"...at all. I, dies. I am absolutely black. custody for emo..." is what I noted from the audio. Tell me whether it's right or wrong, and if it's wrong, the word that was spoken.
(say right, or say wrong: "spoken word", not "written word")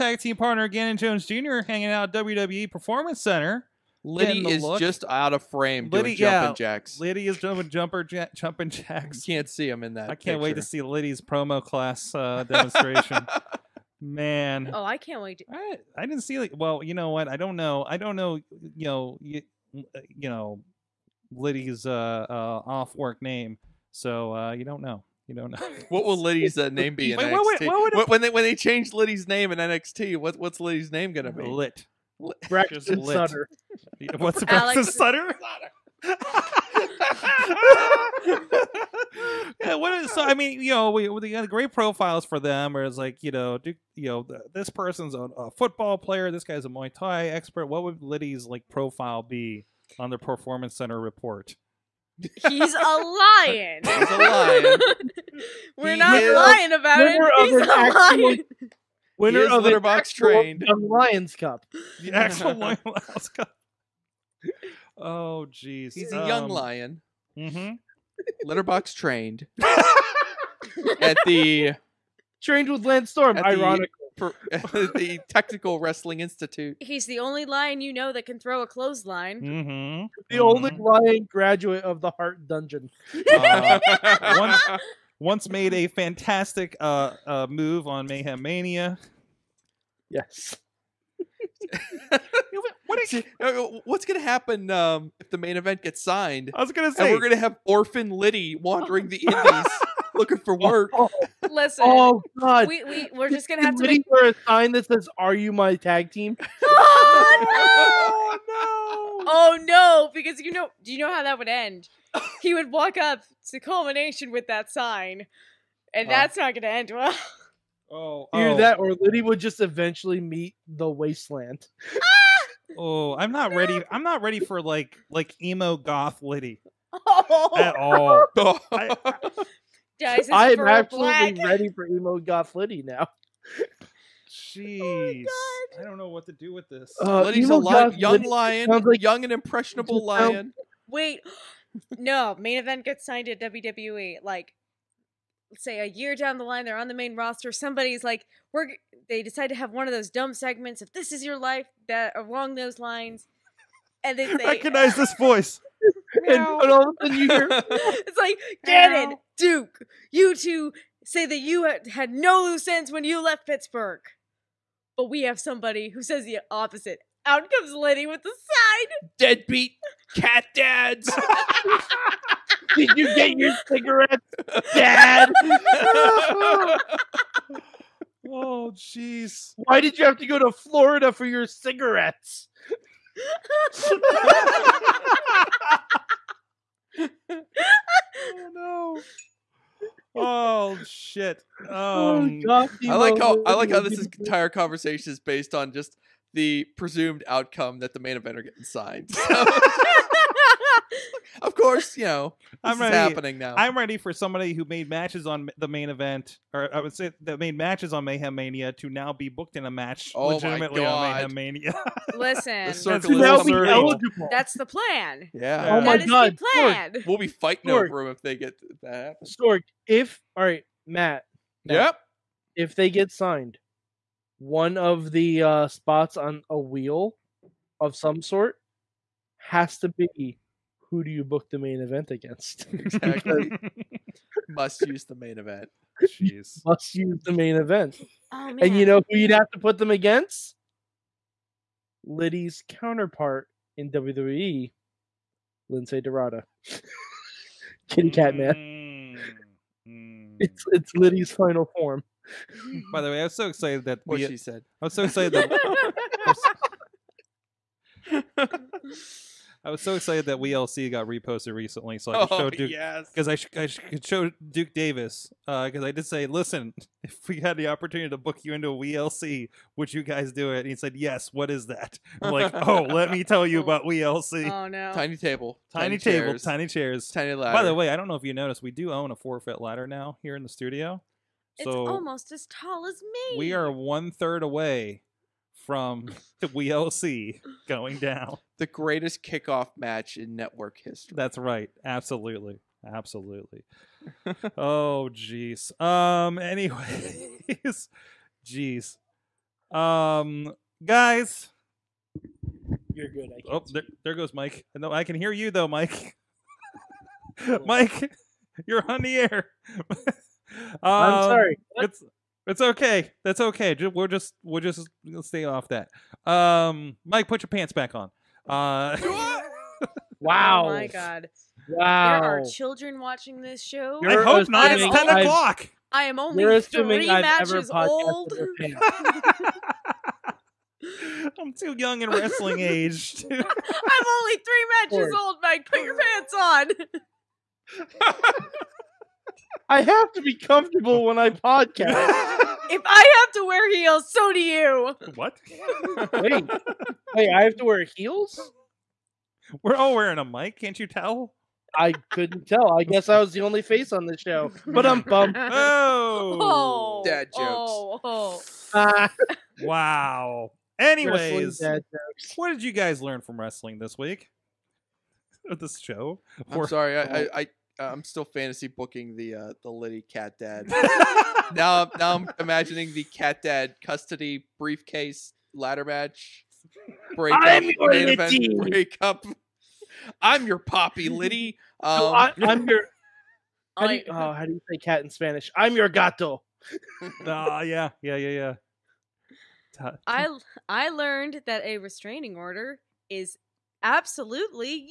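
wrong: "ready", not "custody".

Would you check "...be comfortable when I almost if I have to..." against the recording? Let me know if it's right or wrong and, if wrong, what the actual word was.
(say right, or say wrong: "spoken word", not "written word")
wrong: "podcast", not "almost".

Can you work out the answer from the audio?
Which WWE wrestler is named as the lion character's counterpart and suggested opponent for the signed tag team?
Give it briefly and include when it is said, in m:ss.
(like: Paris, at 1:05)
Lince Dorado, at 4:05.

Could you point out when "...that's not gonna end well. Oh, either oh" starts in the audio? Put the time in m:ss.
1:56.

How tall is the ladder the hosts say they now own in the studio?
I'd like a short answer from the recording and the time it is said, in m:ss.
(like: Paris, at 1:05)
4 feet, at 4:39.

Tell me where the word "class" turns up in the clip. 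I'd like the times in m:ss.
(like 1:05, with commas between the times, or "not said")
0:11.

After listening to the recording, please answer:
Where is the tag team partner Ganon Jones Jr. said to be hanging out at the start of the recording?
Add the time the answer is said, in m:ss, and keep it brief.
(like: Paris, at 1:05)
WWE Performance Center, at 0:02.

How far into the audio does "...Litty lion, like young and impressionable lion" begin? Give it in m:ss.
2:18.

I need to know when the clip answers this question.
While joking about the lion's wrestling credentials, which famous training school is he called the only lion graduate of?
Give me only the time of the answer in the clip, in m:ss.
1:22.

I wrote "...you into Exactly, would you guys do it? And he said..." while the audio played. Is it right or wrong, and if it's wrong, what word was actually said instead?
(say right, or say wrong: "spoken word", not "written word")
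wrong: "WLC", not "Exactly".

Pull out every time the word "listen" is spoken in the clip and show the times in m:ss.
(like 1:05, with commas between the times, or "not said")
1:41, 3:32, 4:26.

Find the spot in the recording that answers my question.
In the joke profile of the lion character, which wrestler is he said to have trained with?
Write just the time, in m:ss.
1:12.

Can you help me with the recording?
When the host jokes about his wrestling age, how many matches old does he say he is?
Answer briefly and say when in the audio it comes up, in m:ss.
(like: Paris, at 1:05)
3, at 5:26.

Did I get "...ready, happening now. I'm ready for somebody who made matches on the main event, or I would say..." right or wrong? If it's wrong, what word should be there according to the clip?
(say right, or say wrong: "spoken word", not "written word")
right.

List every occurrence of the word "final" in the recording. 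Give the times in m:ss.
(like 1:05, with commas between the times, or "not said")
4:11.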